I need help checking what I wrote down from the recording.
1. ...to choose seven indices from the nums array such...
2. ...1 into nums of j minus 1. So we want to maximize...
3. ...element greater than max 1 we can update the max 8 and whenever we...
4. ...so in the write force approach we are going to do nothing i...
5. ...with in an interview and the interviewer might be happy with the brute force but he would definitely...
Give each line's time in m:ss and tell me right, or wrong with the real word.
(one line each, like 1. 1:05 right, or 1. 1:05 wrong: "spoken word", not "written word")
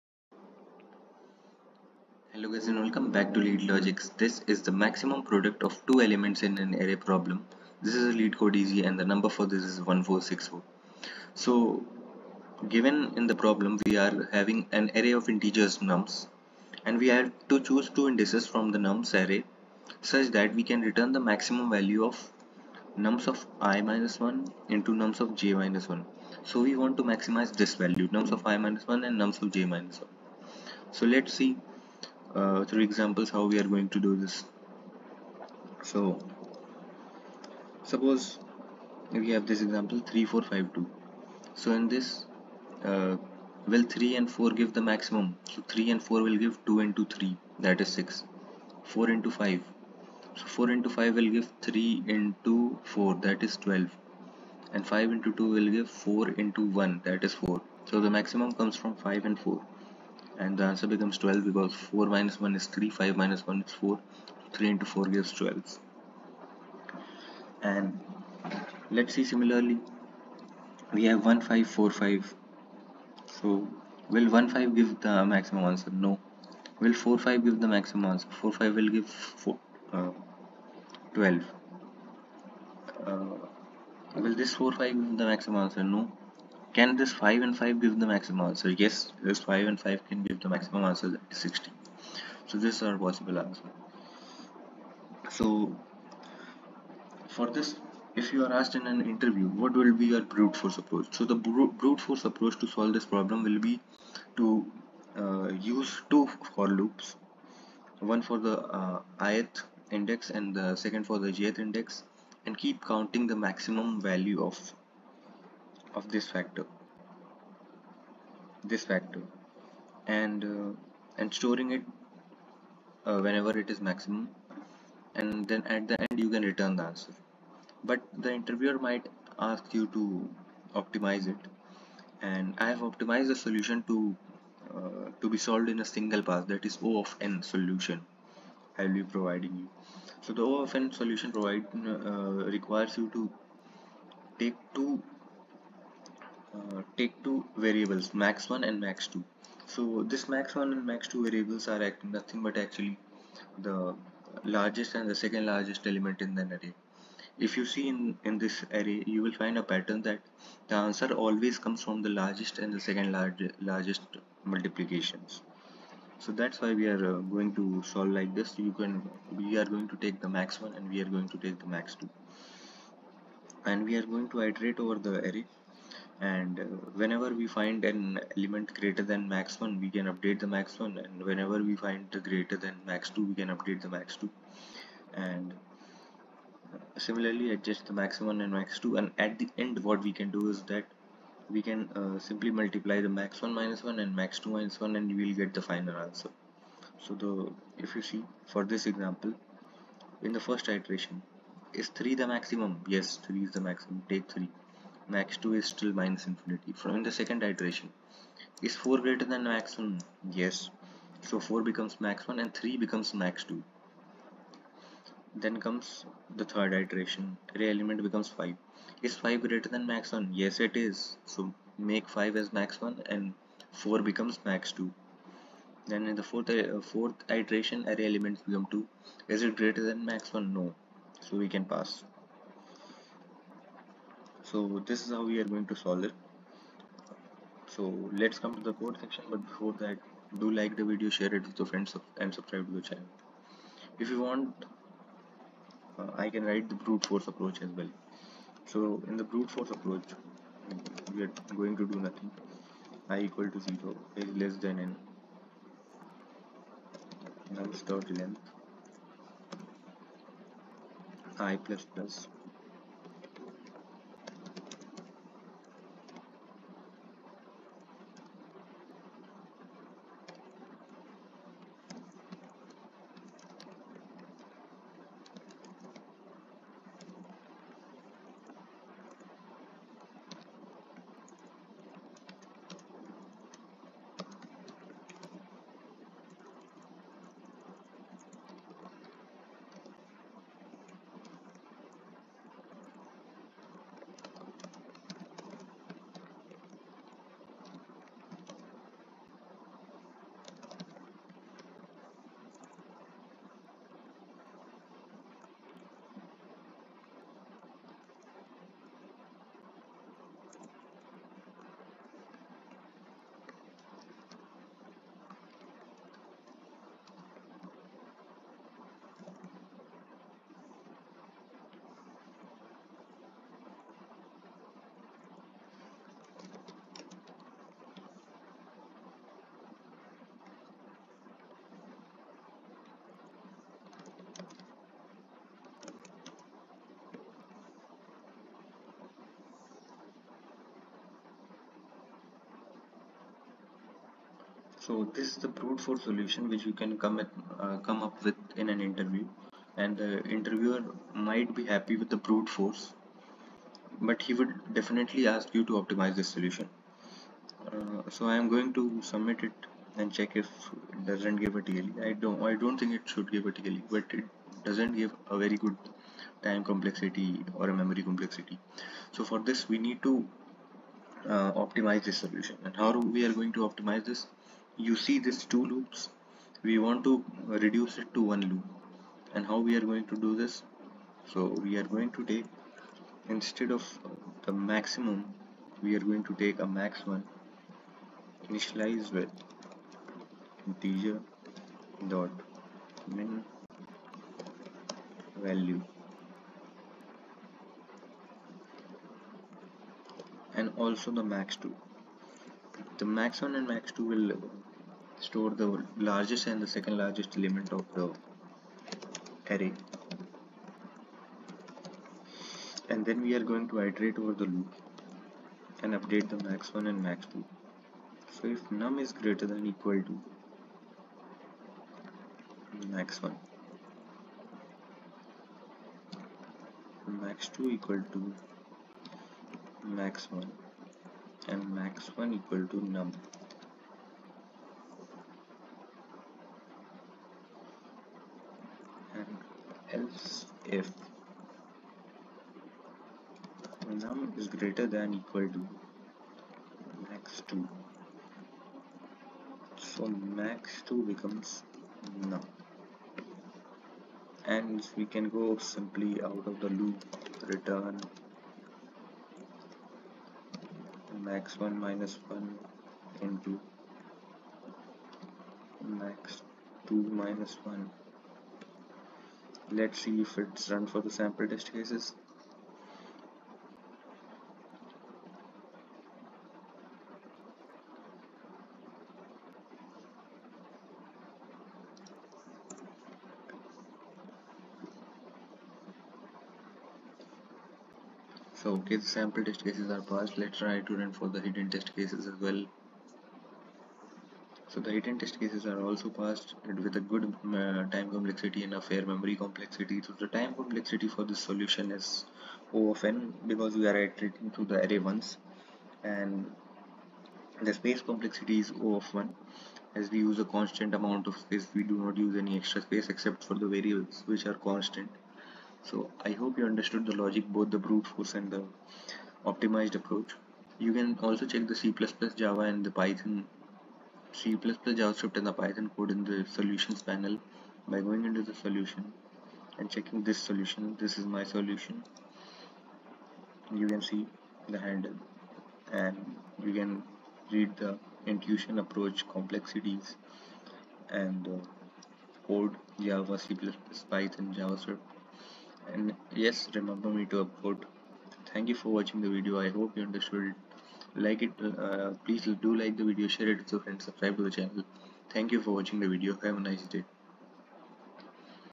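1. 0:17 wrong: "two", not "seven"
2. 0:24 right
3. 2:58 wrong: "1", not "8"
4. 4:08 wrong: "brute", not "write"
5. 5:48 right.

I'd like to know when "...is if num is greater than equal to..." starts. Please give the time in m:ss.
7:20.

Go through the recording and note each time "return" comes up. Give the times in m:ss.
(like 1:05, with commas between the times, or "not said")
0:20, 2:06, 7:37.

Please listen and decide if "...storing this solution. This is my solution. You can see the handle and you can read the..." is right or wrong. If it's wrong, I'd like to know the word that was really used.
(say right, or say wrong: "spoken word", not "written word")
wrong: "checking", not "storing".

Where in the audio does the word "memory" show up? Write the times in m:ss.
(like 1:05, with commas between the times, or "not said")
6:07, 8:19.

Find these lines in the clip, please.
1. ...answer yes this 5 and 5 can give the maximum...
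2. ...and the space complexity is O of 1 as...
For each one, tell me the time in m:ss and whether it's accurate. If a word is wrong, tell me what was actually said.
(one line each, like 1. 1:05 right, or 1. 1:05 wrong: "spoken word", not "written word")
1. 1:28 right
2. 8:26 right.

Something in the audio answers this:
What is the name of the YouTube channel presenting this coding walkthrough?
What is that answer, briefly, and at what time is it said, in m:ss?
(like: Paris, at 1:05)
Leet Logics, at 0:03.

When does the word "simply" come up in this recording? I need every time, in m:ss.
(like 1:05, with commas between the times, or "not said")
3:12, 7:35.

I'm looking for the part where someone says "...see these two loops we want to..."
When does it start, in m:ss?
6:15.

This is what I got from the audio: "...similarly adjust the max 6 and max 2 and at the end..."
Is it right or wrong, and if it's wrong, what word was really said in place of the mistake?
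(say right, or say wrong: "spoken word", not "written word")
wrong: "1", not "6".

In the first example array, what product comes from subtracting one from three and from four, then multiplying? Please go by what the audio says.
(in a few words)
6.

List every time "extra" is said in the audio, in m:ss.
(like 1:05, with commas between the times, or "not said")
8:32.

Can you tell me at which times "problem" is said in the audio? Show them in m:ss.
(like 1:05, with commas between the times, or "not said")
0:06, 0:13, 1:43.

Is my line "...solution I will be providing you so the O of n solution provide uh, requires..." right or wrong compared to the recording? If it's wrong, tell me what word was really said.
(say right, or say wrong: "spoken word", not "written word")
right.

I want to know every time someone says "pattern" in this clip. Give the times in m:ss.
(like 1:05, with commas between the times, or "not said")
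2:39.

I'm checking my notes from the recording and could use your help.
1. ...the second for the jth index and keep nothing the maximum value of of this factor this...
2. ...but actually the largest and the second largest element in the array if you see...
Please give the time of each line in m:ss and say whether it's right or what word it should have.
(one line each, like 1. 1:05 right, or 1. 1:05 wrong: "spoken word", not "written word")
1. 1:50 wrong: "counting", not "nothing"
2. 2:32 right.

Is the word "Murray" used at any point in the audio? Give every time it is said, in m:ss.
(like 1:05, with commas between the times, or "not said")
not said.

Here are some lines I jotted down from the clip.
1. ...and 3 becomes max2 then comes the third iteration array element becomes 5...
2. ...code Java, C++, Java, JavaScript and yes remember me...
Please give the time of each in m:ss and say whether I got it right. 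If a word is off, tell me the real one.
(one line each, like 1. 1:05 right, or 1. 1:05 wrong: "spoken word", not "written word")
1. 3:32 right
2. 9:02 wrong: "Python", not "Java".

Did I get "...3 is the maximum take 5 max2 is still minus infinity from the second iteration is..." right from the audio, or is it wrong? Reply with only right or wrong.
wrong.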